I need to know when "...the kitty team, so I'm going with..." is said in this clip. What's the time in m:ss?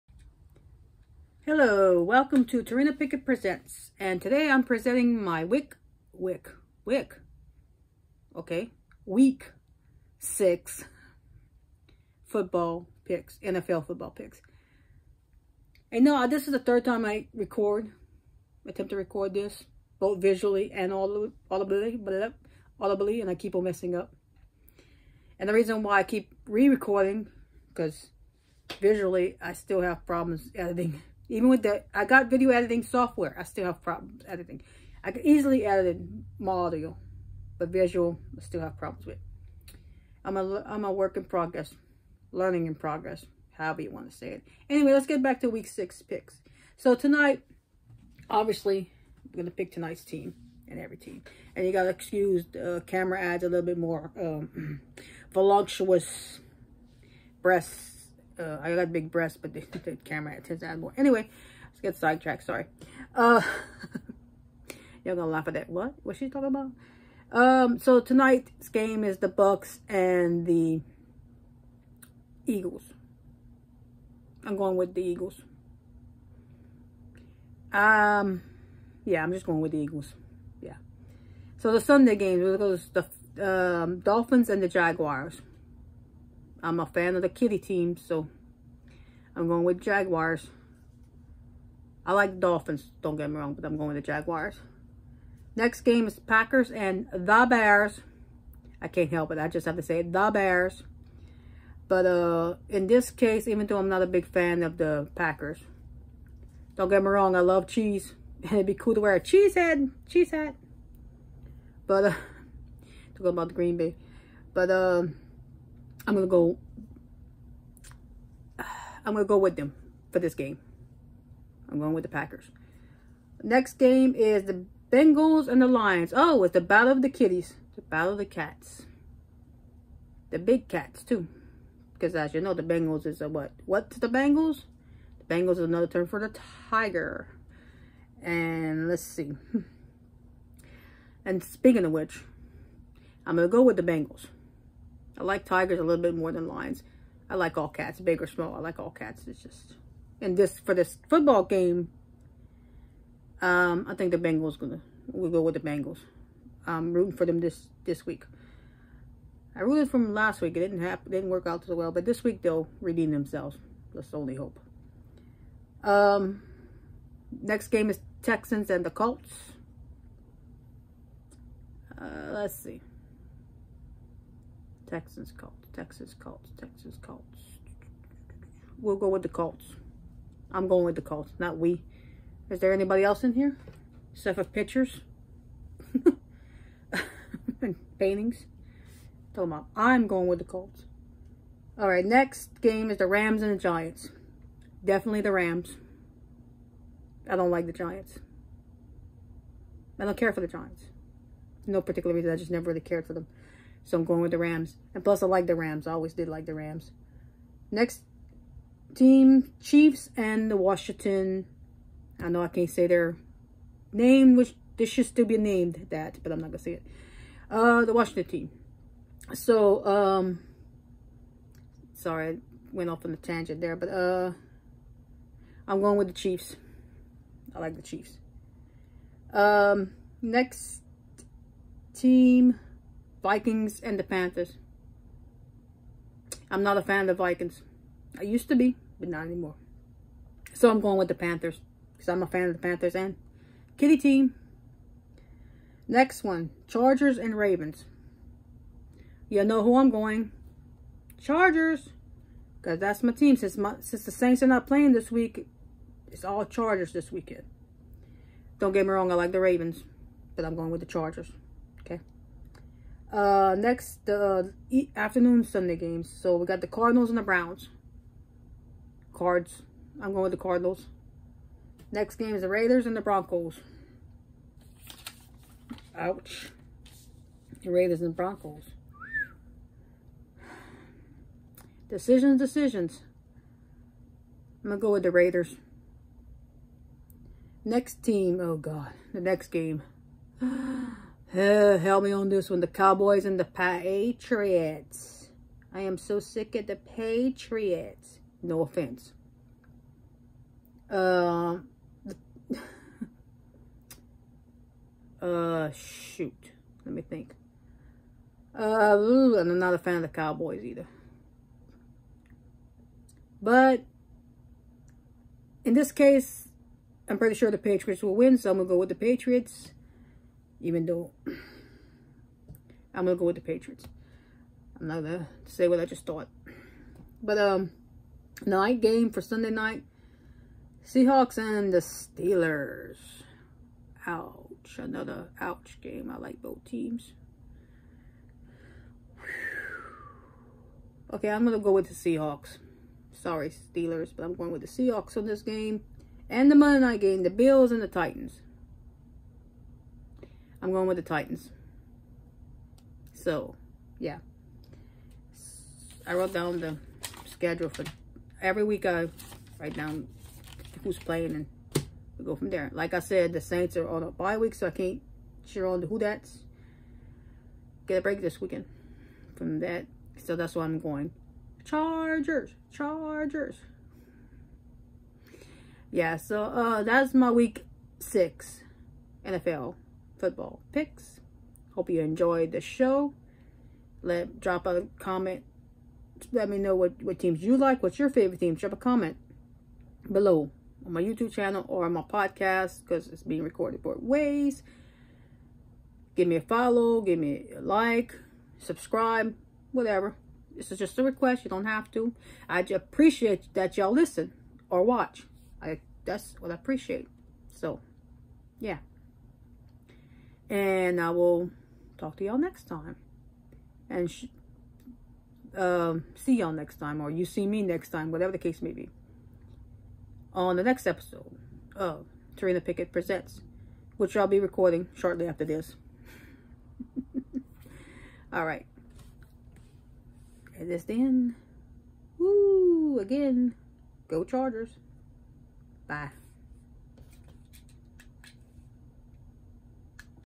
1:27.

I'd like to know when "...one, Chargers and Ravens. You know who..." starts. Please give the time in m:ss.
4:06.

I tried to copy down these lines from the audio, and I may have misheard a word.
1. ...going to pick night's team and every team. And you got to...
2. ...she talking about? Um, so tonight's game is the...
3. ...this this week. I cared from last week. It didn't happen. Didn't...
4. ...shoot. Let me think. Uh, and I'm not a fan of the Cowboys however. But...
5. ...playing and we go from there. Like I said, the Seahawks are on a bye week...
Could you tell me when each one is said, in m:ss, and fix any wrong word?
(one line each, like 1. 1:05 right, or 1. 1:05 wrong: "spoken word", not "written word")
1. 0:49 wrong: "tonight", not "night"
2. 1:06 right
3. 2:37 wrong: "rooted", not "cared"
4. 5:05 wrong: "either", not "however"
5. 6:00 wrong: "Saints", not "Seahawks".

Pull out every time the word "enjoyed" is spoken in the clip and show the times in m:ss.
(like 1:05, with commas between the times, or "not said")
6:21.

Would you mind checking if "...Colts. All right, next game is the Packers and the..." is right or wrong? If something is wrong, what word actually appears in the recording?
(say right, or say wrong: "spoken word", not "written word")
wrong: "Rams", not "Packers".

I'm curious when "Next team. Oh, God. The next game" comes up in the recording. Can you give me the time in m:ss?
4:47.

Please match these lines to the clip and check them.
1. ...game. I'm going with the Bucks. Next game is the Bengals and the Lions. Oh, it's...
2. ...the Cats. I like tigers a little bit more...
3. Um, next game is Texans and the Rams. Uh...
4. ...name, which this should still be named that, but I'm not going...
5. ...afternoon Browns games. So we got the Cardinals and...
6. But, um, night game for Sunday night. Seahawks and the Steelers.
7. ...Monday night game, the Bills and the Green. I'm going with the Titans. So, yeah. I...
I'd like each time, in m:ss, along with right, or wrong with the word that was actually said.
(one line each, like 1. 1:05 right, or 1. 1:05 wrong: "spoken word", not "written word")
1. 2:00 wrong: "Packers", not "Bucks"
2. 2:23 wrong: "Bengals", not "Cats"
3. 2:45 wrong: "Colts", not "Rams"
4. 3:33 right
5. 4:24 wrong: "Sunday", not "Browns"
6. 5:27 right
7. 5:46 wrong: "Titans", not "Green".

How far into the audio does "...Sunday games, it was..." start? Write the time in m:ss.
1:21.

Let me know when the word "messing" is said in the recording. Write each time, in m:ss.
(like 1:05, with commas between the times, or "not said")
0:23.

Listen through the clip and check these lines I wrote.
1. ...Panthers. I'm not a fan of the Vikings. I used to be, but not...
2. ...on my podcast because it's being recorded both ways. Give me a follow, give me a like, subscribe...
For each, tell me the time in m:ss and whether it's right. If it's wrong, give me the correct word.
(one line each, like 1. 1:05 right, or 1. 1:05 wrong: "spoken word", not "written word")
1. 3:54 right
2. 6:31 right.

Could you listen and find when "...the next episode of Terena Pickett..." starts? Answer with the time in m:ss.
7:00.